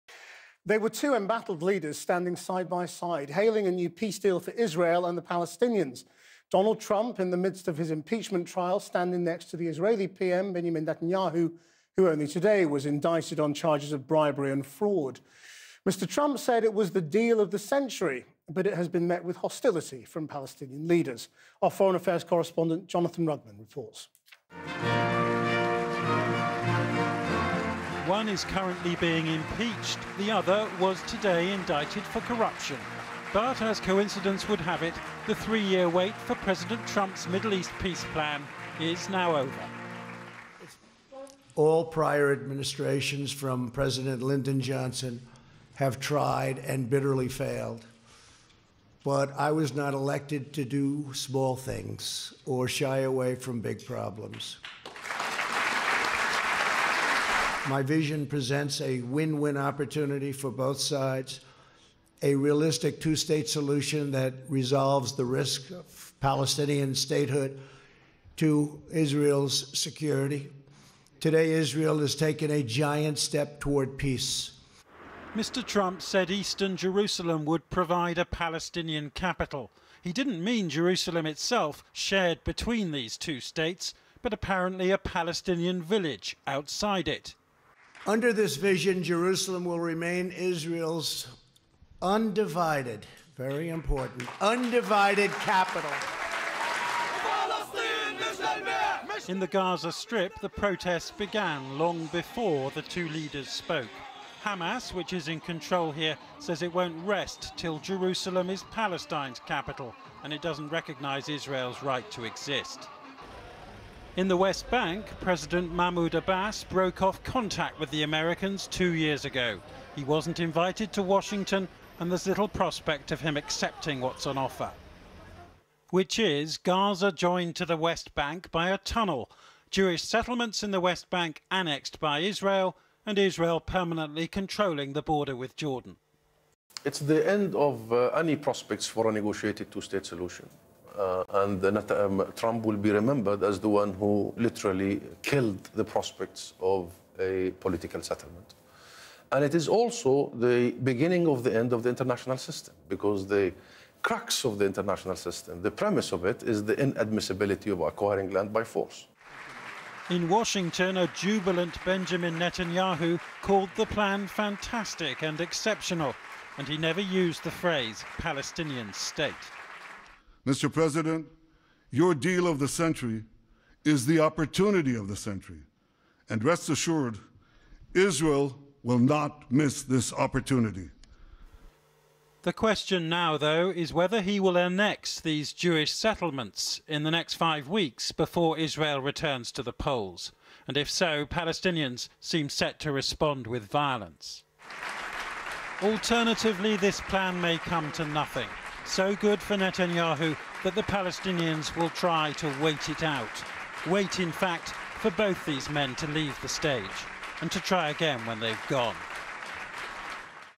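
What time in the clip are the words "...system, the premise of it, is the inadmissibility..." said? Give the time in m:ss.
2:35.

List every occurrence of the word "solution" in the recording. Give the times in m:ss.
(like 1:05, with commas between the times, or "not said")
1:03, 2:20.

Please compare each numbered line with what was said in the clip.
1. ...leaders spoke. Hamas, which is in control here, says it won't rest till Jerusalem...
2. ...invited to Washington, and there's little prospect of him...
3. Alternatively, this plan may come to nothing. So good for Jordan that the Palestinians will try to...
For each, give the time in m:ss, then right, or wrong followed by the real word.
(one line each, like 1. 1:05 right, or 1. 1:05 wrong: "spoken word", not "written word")
1. 1:43 right
2. 2:00 right
3. 3:15 wrong: "Netanyahu", not "Jordan".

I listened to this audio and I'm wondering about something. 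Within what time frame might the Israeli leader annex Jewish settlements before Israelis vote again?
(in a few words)
5 weeks.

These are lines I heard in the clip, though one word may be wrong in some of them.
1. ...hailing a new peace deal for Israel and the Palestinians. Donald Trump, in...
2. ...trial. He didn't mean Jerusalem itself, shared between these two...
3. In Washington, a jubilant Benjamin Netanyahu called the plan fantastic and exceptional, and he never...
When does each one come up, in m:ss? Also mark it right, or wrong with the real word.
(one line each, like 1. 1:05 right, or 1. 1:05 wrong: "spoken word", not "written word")
1. 0:03 right
2. 1:19 wrong: "capital", not "trial"
3. 2:40 right.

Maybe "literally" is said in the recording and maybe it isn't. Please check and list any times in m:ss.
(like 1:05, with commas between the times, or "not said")
2:24.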